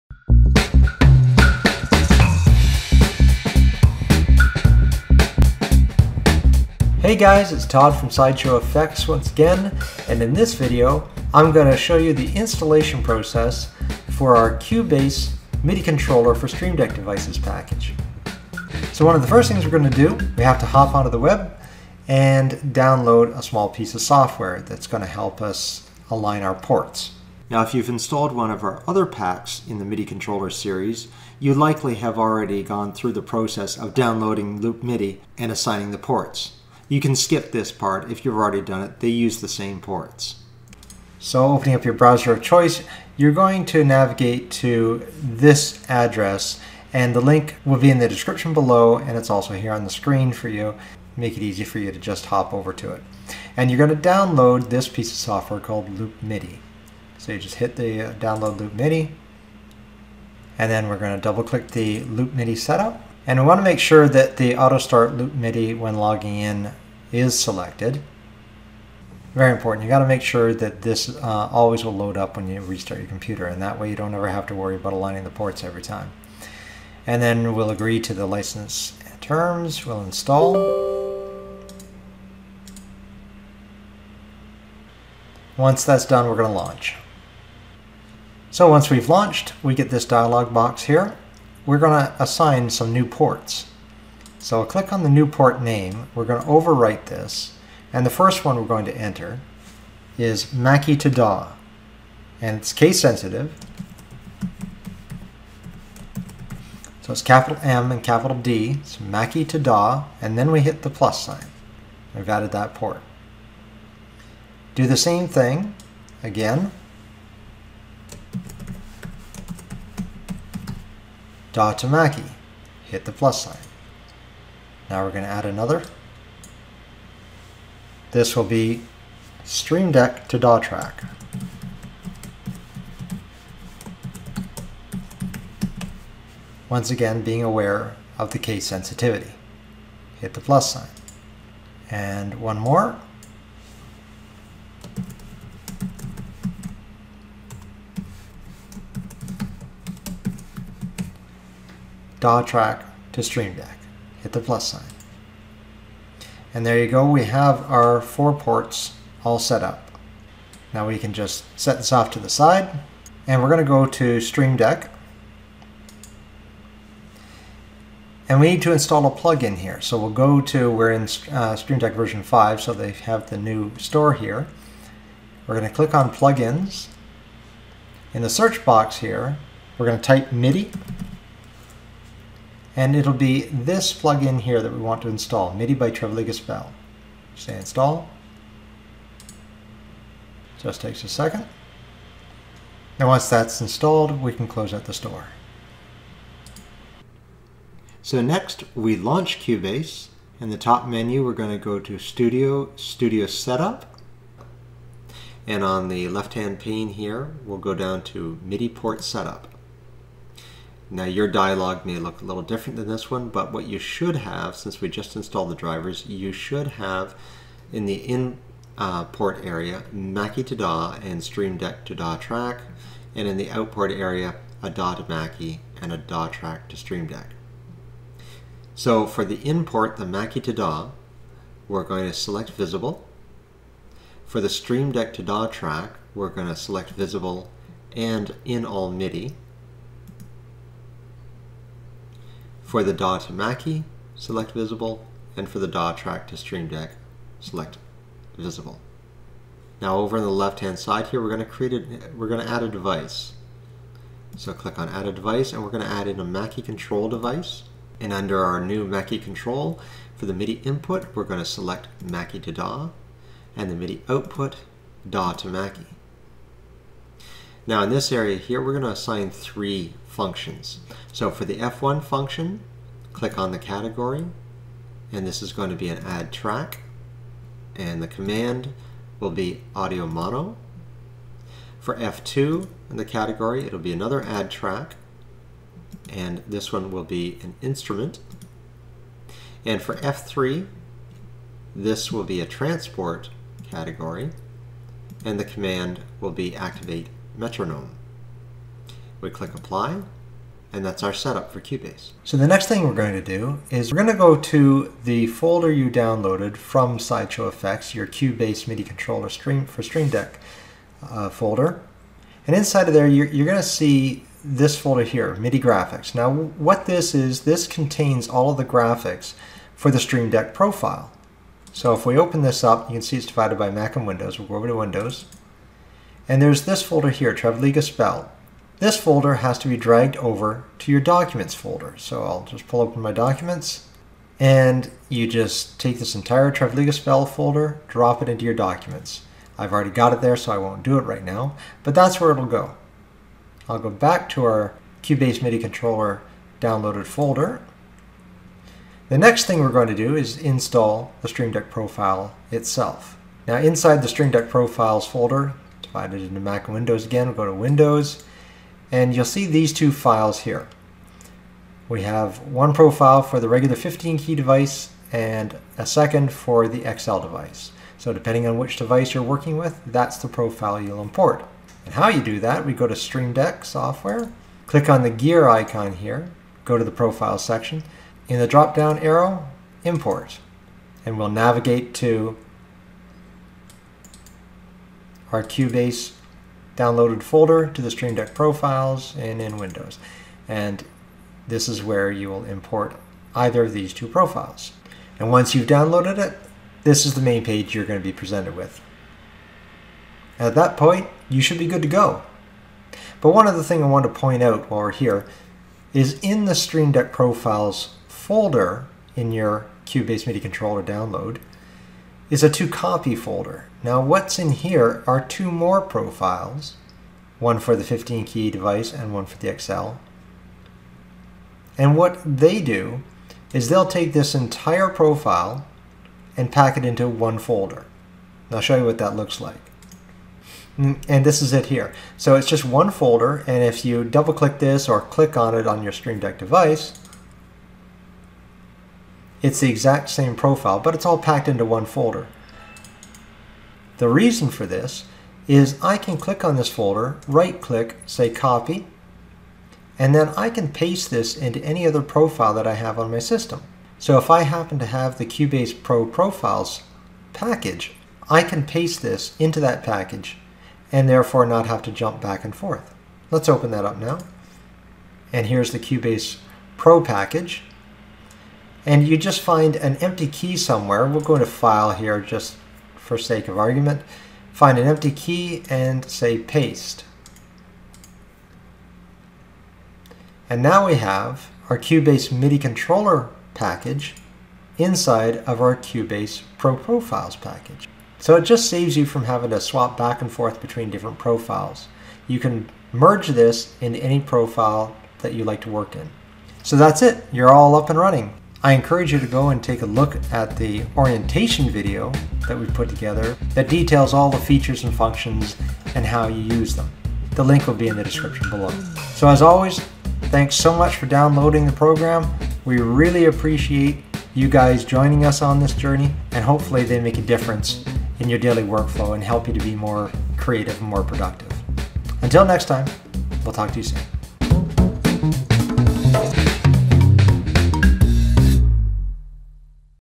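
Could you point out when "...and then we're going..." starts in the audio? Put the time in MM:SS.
01:00.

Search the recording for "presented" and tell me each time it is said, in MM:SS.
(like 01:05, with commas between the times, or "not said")
06:38.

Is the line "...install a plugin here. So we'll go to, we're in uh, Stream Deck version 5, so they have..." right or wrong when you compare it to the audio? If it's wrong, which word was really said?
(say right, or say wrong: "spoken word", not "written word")
right.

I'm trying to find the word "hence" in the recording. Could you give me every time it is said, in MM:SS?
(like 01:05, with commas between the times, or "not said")
not said.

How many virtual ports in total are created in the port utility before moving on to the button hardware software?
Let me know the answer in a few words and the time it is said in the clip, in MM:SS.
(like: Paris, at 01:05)
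4, at 02:38.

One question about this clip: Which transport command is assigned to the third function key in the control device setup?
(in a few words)
activate metronome.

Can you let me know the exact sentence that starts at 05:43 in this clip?
I'll go back to our Cubase MIDI controller downloaded folder.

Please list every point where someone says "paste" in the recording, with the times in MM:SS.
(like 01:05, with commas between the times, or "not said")
07:30, 07:38, 07:56.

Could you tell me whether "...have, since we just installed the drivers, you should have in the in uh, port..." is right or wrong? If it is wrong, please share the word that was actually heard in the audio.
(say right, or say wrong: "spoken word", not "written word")
right.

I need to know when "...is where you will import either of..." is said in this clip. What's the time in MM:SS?
06:31.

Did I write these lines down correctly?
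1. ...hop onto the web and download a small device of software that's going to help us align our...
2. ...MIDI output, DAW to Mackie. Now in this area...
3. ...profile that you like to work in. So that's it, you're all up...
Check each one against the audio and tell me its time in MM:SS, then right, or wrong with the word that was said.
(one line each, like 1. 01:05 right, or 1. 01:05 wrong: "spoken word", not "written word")
1. 00:20 wrong: "piece", not "device"
2. 04:23 right
3. 08:14 right.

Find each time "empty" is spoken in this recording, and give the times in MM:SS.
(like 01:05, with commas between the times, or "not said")
07:49, 07:54.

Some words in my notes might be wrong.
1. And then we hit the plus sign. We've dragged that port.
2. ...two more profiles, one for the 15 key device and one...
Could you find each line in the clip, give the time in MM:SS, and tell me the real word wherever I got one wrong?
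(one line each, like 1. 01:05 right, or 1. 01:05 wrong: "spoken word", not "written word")
1. 01:50 wrong: "added", not "dragged"
2. 06:55 right.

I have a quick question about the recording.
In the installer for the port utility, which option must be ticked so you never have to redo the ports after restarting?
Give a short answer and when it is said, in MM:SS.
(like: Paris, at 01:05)
auto start Loop MIDI when logging in, at 01:04.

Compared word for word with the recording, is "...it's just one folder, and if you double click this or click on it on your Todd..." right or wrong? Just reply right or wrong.
wrong.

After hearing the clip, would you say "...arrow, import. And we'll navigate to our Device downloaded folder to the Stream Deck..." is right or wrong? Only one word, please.
wrong.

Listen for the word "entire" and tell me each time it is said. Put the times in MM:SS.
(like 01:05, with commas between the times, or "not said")
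05:36, 07:04.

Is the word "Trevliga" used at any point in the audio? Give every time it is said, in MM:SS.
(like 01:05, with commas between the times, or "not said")
03:05, 05:27, 05:36.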